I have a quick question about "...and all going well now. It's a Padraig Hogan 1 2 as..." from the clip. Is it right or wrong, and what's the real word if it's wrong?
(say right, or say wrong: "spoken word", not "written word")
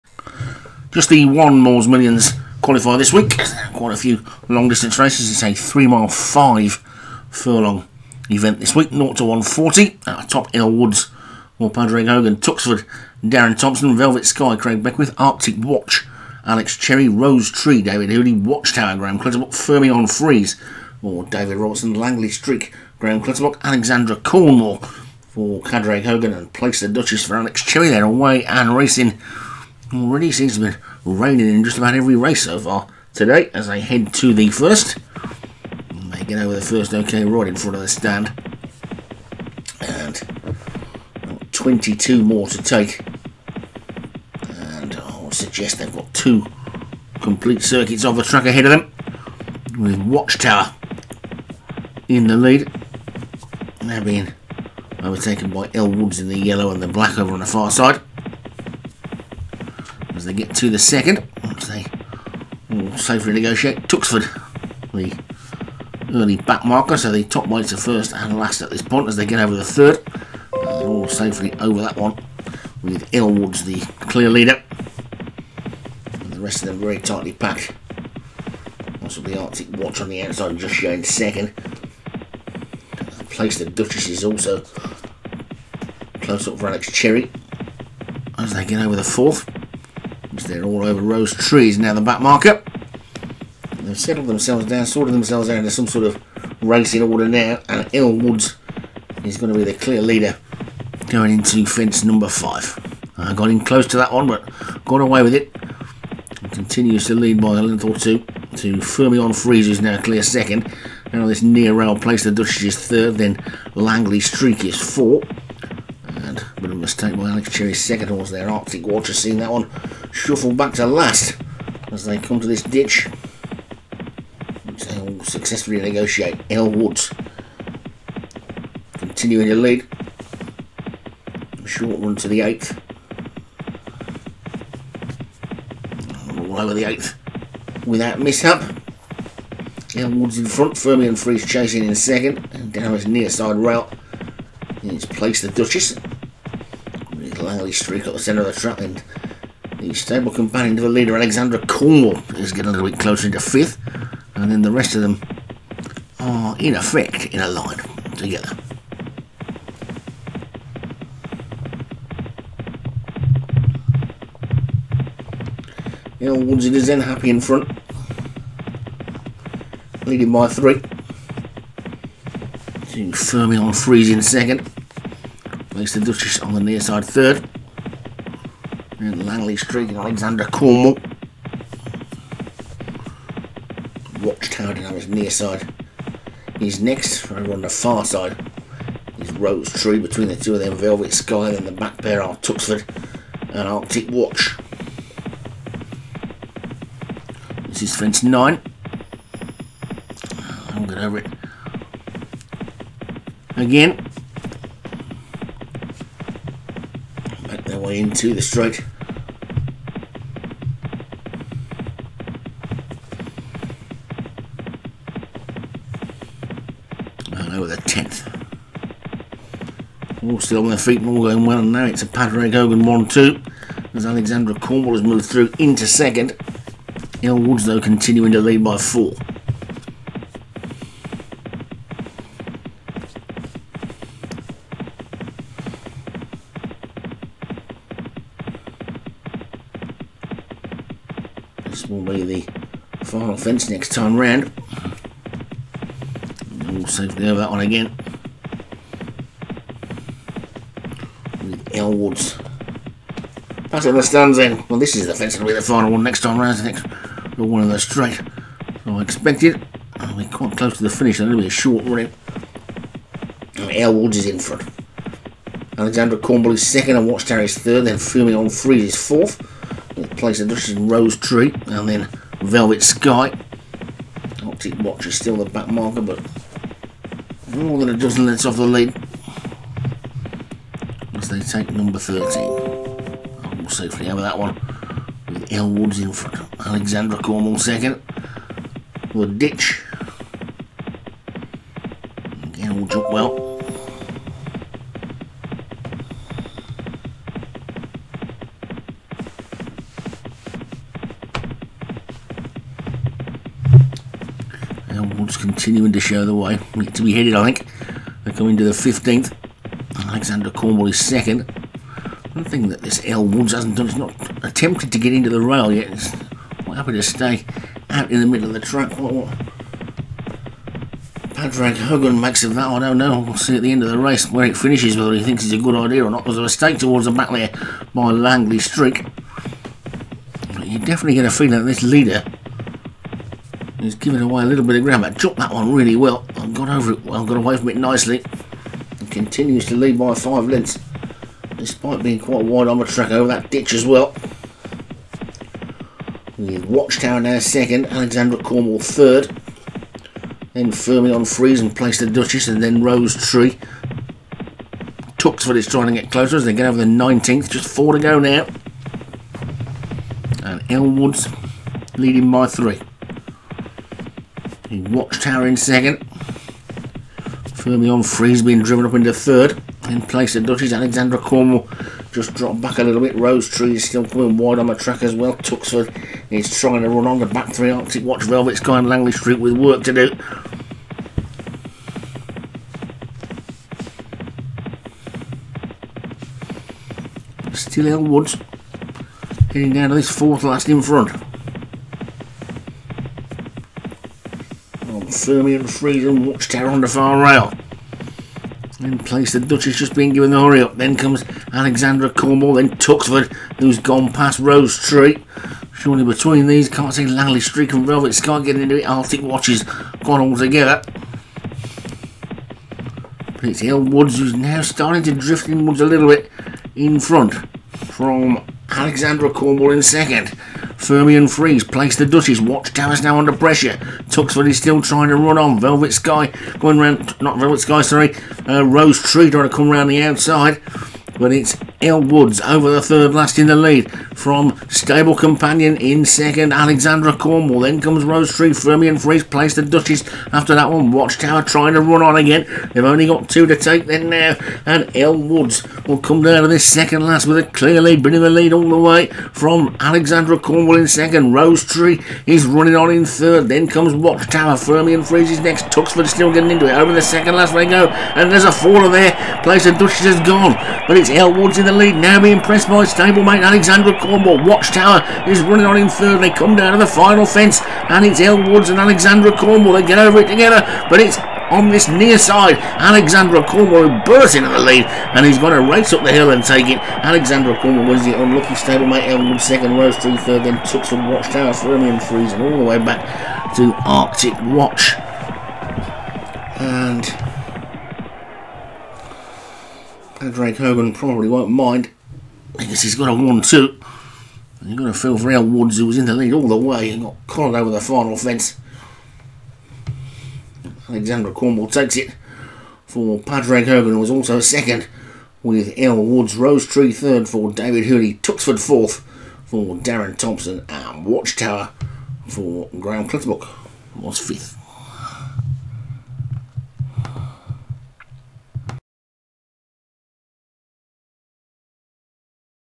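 right.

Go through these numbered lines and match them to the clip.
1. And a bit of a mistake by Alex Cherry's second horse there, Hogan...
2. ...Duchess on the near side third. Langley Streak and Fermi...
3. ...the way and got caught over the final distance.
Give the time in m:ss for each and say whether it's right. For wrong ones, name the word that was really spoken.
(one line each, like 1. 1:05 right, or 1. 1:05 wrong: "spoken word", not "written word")
1. 1:56 wrong: "Arctic", not "Hogan"
2. 2:56 wrong: "Alexandra", not "Fermi"
3. 8:16 wrong: "fence", not "distance".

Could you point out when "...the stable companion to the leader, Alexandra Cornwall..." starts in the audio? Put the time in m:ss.
2:29.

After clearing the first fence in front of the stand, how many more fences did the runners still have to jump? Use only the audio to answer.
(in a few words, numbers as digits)
22.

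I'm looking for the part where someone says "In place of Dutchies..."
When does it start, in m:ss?
6:09.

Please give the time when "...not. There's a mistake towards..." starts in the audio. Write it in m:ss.
5:26.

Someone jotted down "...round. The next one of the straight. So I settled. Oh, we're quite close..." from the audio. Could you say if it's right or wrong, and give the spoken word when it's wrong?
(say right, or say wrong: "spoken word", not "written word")
wrong: "expected", not "settled".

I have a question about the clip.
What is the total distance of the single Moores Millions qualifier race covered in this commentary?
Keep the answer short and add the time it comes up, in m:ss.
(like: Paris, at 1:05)
3 miles 5 furlongs, at 0:05.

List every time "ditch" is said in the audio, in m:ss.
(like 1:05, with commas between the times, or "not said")
2:02, 4:49, 5:43.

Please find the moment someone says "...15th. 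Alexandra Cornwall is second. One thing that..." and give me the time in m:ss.
5:08.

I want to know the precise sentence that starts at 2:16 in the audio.
All over the eighth without mishap.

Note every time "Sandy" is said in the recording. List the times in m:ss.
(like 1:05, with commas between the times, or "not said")
not said.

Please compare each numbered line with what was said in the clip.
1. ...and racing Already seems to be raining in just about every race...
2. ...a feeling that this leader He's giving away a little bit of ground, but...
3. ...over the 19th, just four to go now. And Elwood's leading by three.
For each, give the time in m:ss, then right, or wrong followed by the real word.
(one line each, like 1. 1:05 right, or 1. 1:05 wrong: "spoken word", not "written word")
1. 0:28 right
2. 5:31 right
3. 5:56 right.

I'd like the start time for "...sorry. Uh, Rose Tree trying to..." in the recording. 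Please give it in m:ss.
7:07.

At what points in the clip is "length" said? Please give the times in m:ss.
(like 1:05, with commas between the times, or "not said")
1:47, 5:40.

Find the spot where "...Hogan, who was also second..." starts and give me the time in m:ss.
8:23.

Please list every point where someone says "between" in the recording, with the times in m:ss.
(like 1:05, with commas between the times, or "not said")
3:09, 6:46.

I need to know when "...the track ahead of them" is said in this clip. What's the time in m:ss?
0:48.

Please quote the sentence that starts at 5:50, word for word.
Then firmly on freeze and place the Duchess and then Rose Tree.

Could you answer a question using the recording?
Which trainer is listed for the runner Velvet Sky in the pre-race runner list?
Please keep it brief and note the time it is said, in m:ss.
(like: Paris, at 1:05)
Craig Beckwith, at 0:14.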